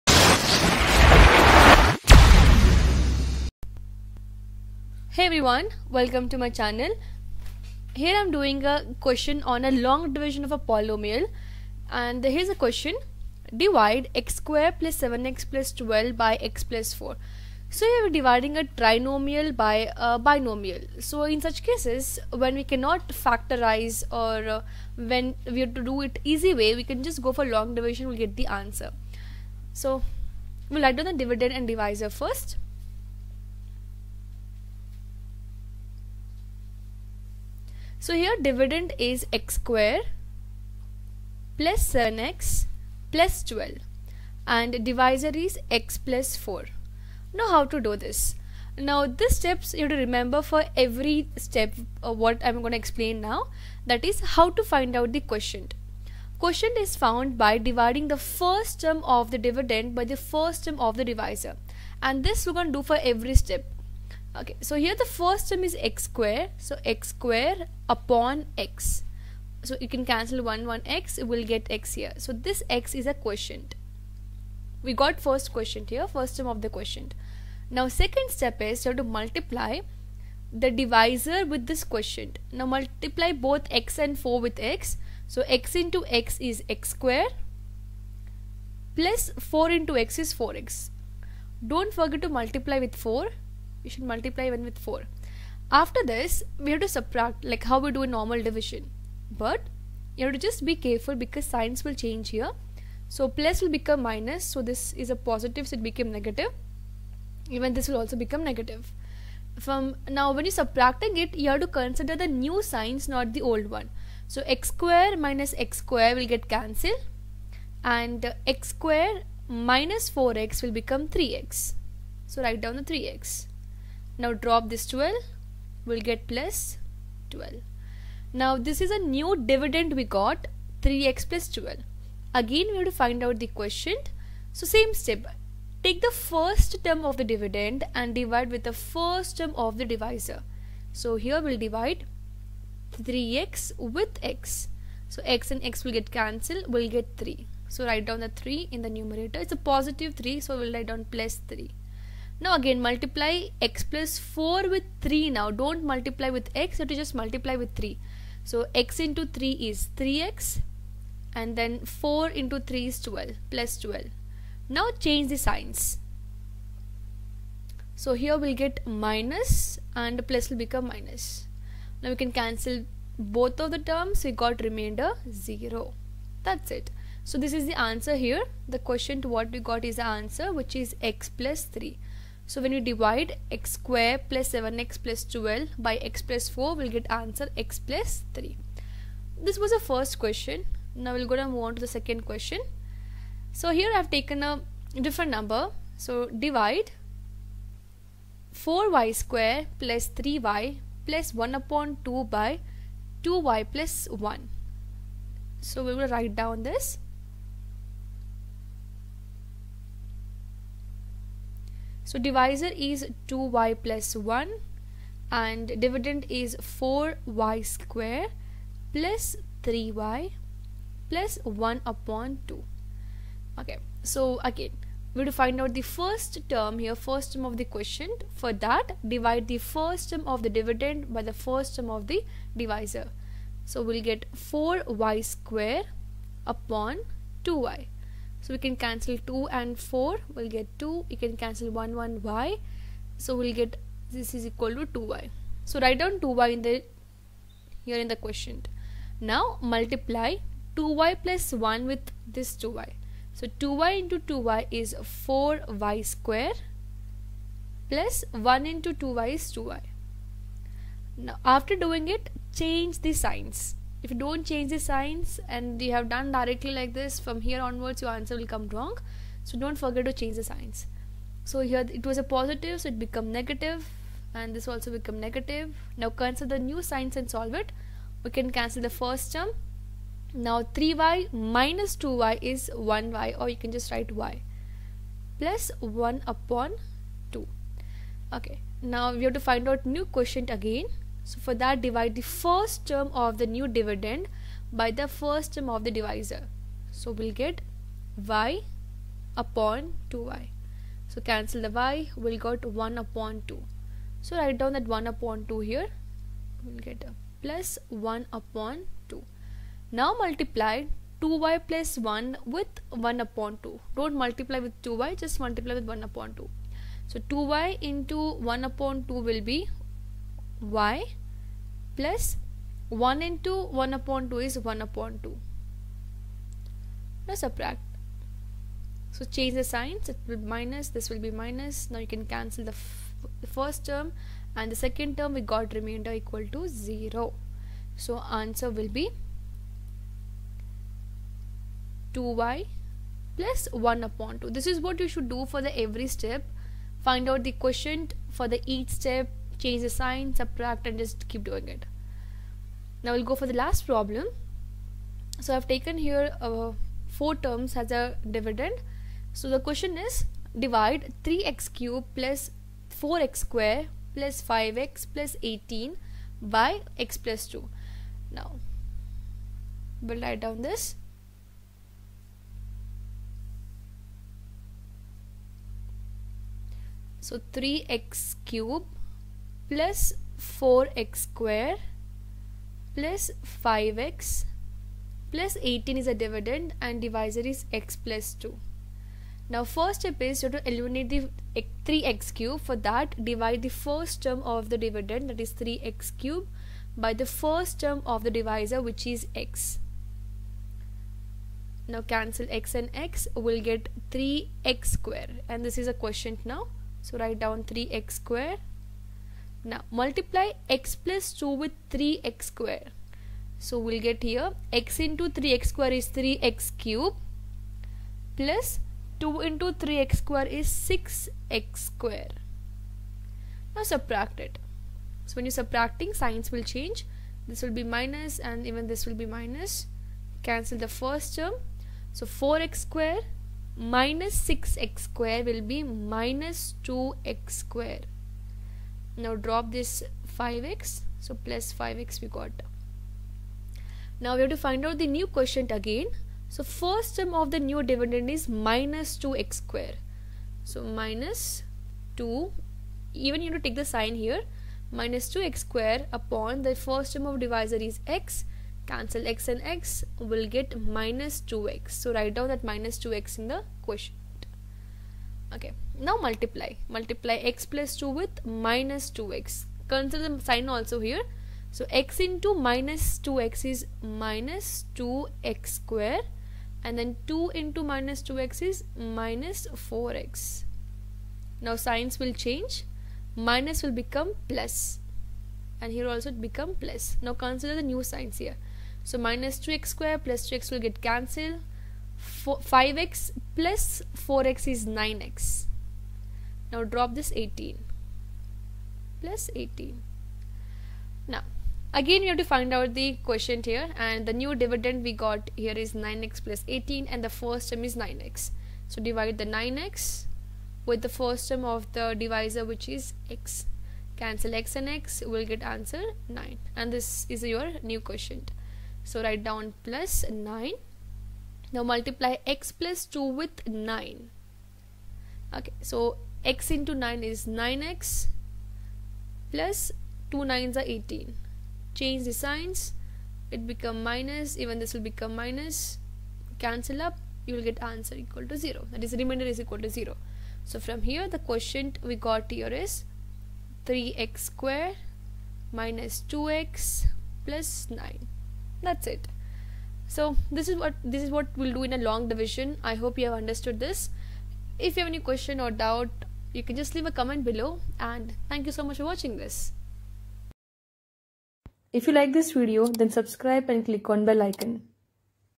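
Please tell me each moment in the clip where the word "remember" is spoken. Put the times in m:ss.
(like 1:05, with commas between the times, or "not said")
0:49.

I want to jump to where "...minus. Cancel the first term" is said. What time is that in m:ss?
7:09.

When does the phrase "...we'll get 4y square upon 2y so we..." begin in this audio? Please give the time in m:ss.
3:53.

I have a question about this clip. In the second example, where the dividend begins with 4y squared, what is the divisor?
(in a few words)
2y + 1.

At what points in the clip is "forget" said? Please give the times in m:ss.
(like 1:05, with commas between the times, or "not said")
1:31, 4:29.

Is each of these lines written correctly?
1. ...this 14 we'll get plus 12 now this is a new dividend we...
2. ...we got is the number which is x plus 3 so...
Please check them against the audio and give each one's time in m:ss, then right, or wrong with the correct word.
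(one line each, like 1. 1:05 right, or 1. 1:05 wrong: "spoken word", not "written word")
1. 2:04 wrong: "12", not "14"
2. 2:59 wrong: "answer", not "number".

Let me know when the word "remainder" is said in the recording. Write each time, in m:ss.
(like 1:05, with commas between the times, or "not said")
2:54, 5:35, 8:59.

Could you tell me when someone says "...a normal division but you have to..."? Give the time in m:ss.
1:38.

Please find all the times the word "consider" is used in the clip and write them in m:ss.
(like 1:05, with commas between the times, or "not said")
1:51, 7:49, 8:07.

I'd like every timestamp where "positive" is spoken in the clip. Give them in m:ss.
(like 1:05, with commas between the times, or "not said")
1:45, 2:29, 4:32.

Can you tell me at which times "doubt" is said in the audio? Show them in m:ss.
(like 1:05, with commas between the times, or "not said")
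9:15.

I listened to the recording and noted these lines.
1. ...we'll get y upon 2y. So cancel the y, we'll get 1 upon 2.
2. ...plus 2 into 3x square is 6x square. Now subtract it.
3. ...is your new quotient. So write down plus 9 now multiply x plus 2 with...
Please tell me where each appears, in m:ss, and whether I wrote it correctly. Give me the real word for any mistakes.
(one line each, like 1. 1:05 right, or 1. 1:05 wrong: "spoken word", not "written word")
1. 4:57 right
2. 6:58 right
3. 8:37 right.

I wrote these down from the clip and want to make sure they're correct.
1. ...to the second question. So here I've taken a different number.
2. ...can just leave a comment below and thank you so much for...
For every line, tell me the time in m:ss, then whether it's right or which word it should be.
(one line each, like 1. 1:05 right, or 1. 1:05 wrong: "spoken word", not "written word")
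1. 3:11 right
2. 9:16 right.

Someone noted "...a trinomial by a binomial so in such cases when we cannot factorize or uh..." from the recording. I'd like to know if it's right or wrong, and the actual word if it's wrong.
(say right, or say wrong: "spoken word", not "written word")
right.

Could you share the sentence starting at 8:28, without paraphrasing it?
So divide the 9x with the first term of the divisor which is x.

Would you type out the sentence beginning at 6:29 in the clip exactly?
Now first step is you have to eliminate the 3x cube.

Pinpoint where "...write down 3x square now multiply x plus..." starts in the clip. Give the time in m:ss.
6:47.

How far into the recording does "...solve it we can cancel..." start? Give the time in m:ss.
4:37.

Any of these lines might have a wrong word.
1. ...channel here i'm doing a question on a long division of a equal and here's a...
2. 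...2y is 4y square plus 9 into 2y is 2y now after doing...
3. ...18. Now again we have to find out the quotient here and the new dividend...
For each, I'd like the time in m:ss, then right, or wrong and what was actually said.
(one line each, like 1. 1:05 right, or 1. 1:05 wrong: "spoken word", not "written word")
1. 0:06 wrong: "polynomial", not "equal"
2. 4:14 wrong: "1", not "9"
3. 8:19 right.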